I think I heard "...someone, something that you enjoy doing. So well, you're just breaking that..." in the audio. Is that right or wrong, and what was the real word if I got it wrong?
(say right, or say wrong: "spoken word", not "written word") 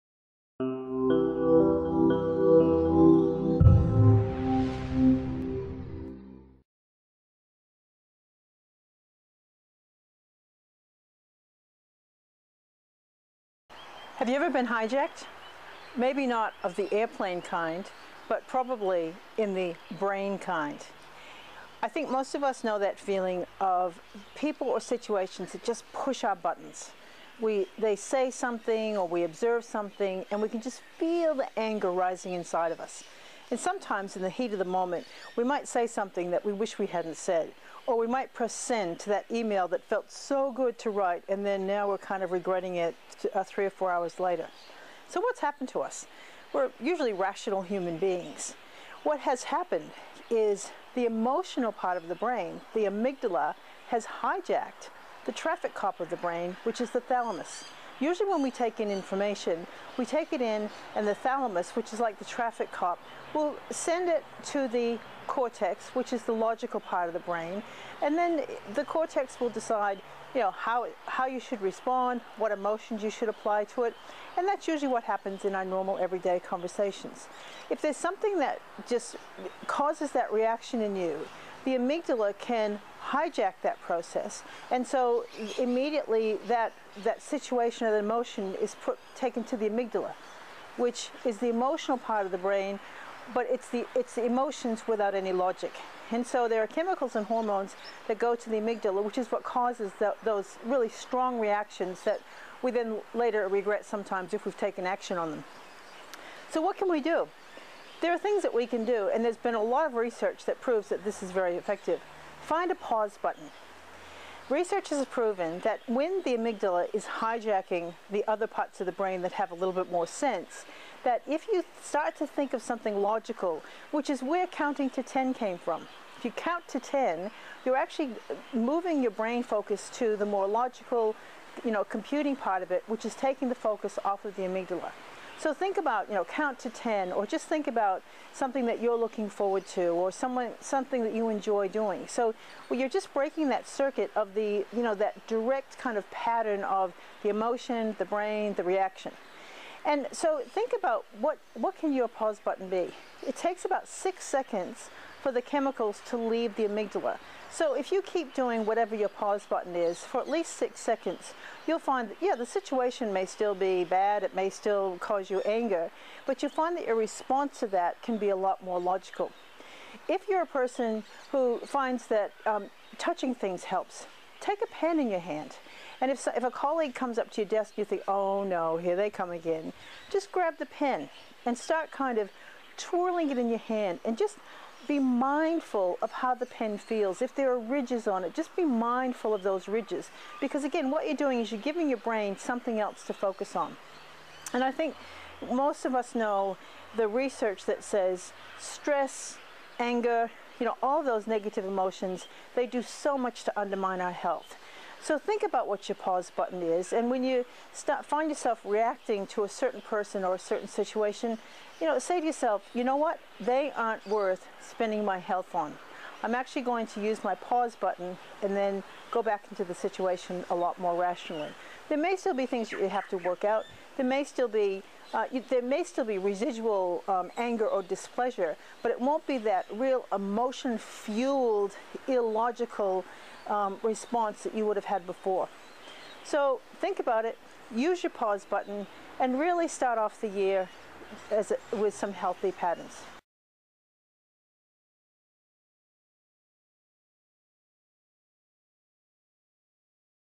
right.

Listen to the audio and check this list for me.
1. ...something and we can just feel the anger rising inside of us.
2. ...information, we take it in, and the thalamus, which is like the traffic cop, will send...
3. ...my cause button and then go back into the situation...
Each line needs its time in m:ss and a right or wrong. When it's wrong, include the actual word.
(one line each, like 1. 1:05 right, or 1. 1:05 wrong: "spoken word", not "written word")
1. 0:29 right
2. 0:58 right
3. 3:37 wrong: "pause", not "cause".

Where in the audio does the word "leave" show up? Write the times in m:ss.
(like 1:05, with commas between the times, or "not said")
2:36.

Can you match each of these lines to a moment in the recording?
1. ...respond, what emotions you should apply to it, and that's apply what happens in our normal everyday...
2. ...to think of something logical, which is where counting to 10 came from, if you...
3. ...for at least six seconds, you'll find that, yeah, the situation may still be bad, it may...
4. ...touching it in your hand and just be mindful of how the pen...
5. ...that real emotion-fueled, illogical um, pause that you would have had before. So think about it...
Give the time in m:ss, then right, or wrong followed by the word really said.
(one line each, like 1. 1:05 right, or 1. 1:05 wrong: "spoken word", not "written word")
1. 1:11 wrong: "usually", not "apply"
2. 2:02 right
3. 2:39 right
4. 3:02 wrong: "twirling", not "touching"
5. 3:49 wrong: "response", not "pause".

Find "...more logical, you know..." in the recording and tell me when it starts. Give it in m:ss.
2:10.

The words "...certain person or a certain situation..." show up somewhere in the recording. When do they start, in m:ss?
3:29.